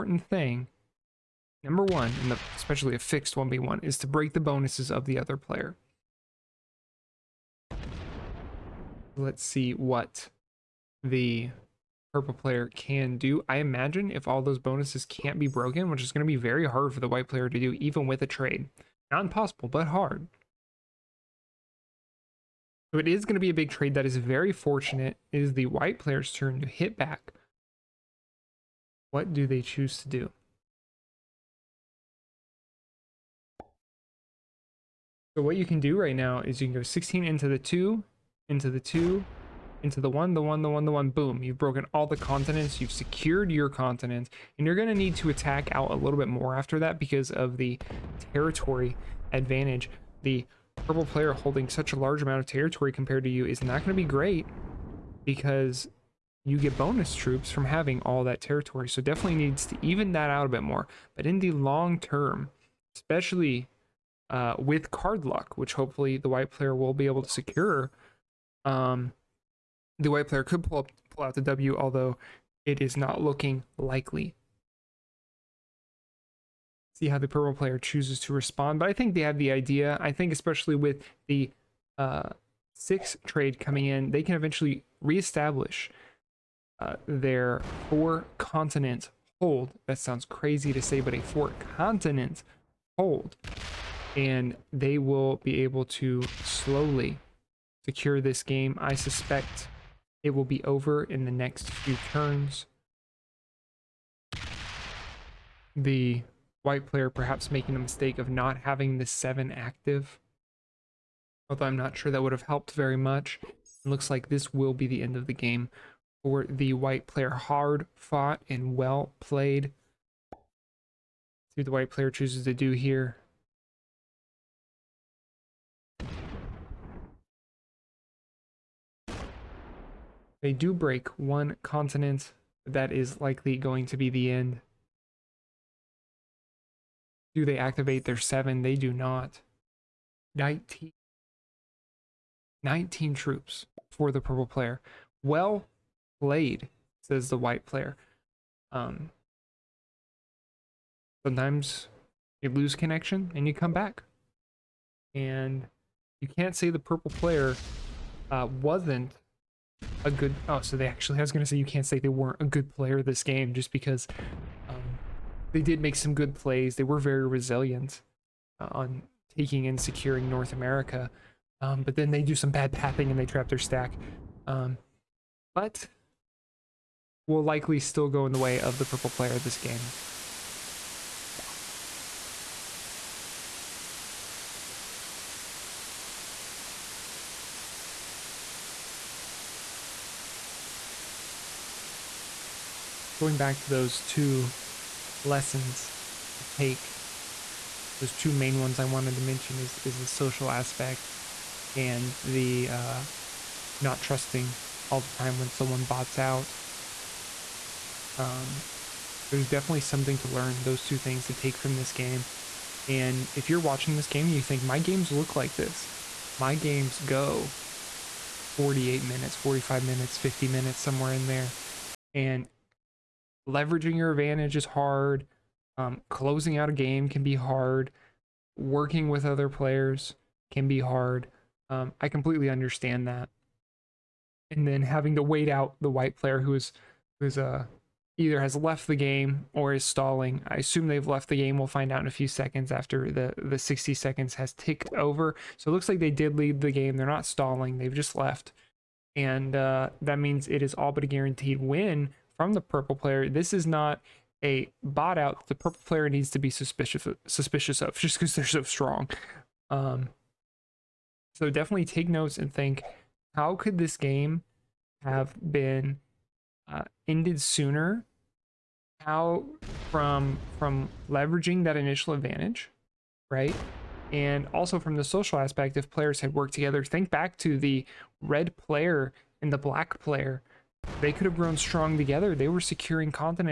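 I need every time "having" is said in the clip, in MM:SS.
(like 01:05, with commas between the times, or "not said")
00:57, 01:48, 03:54.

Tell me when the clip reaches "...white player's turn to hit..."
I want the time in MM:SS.
00:25.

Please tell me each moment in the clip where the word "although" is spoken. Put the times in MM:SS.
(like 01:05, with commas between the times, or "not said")
01:11, 01:51.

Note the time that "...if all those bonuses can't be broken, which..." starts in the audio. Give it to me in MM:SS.
00:14.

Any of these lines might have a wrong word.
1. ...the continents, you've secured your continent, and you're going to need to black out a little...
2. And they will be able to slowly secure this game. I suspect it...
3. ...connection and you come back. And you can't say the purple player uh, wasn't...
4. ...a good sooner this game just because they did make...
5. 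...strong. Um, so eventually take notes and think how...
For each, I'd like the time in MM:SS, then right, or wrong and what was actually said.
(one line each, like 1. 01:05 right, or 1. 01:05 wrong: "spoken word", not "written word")
1. 00:42 wrong: "attack", not "black"
2. 01:34 right
3. 02:32 right
4. 02:42 wrong: "player", not "sooner"
5. 04:18 wrong: "definitely", not "eventually".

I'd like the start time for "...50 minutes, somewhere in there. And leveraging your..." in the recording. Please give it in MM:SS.
03:40.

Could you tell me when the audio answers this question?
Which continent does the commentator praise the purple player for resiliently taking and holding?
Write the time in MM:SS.
02:50.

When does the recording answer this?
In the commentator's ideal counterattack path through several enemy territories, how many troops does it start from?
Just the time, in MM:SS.
00:36.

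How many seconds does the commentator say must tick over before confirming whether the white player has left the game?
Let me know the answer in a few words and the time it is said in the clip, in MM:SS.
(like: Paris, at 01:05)
60, at 04:03.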